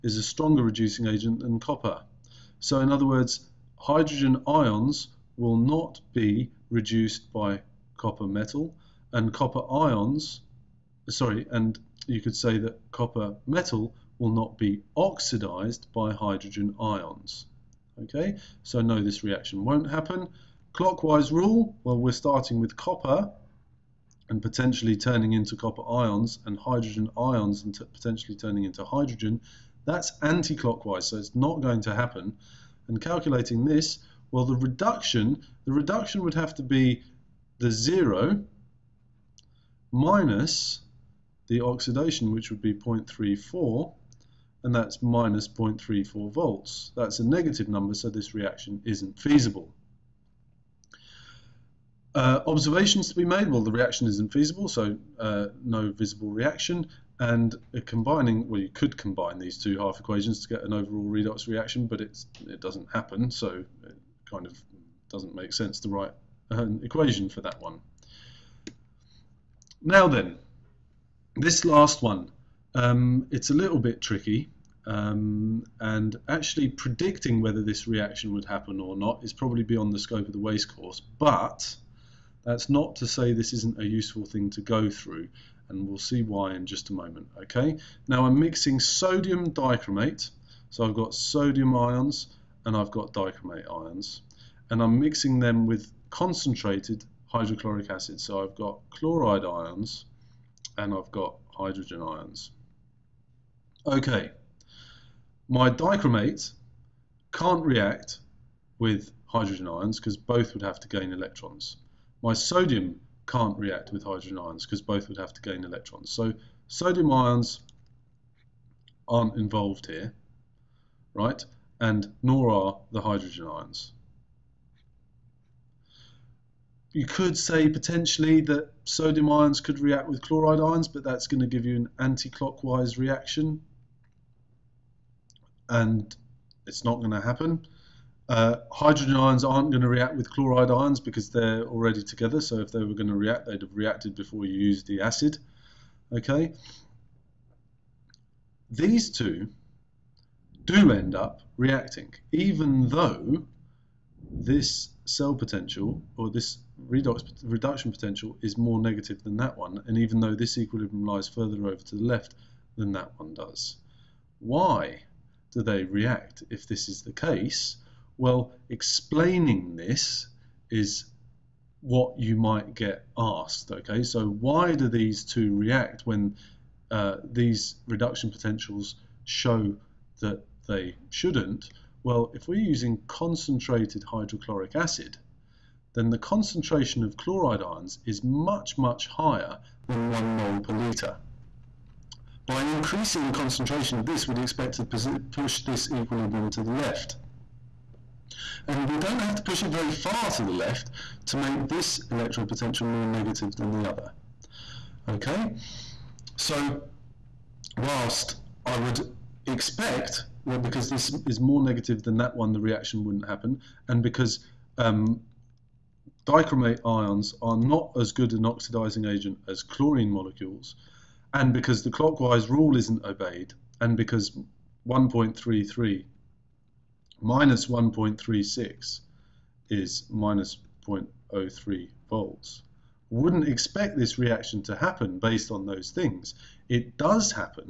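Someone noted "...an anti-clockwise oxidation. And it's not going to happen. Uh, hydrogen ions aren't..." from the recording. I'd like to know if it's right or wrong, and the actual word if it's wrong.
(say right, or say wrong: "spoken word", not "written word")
wrong: "reaction", not "oxidation".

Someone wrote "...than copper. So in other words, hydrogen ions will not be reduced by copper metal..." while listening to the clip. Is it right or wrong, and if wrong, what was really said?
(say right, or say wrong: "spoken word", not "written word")
right.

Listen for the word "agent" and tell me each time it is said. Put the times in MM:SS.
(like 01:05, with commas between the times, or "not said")
00:01, 03:39.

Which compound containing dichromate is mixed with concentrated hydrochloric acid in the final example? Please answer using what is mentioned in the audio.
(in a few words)
sodium dichromate.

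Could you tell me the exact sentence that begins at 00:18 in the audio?
Okay, so no, this reaction won't happen.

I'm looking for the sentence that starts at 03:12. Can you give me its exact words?
By increasing the concentration of this, we'd expect to push this equilibrium to the left.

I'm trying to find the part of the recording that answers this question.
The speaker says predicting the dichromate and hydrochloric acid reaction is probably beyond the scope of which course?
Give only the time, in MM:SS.
01:20.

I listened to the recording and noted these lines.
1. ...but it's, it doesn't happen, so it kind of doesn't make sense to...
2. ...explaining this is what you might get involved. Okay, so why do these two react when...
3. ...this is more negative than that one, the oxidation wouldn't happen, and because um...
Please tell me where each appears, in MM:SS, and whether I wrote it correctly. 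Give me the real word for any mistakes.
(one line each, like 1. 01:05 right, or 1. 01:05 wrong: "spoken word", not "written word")
1. 01:01 right
2. 02:48 wrong: "asked", not "involved"
3. 03:30 wrong: "reaction", not "oxidation".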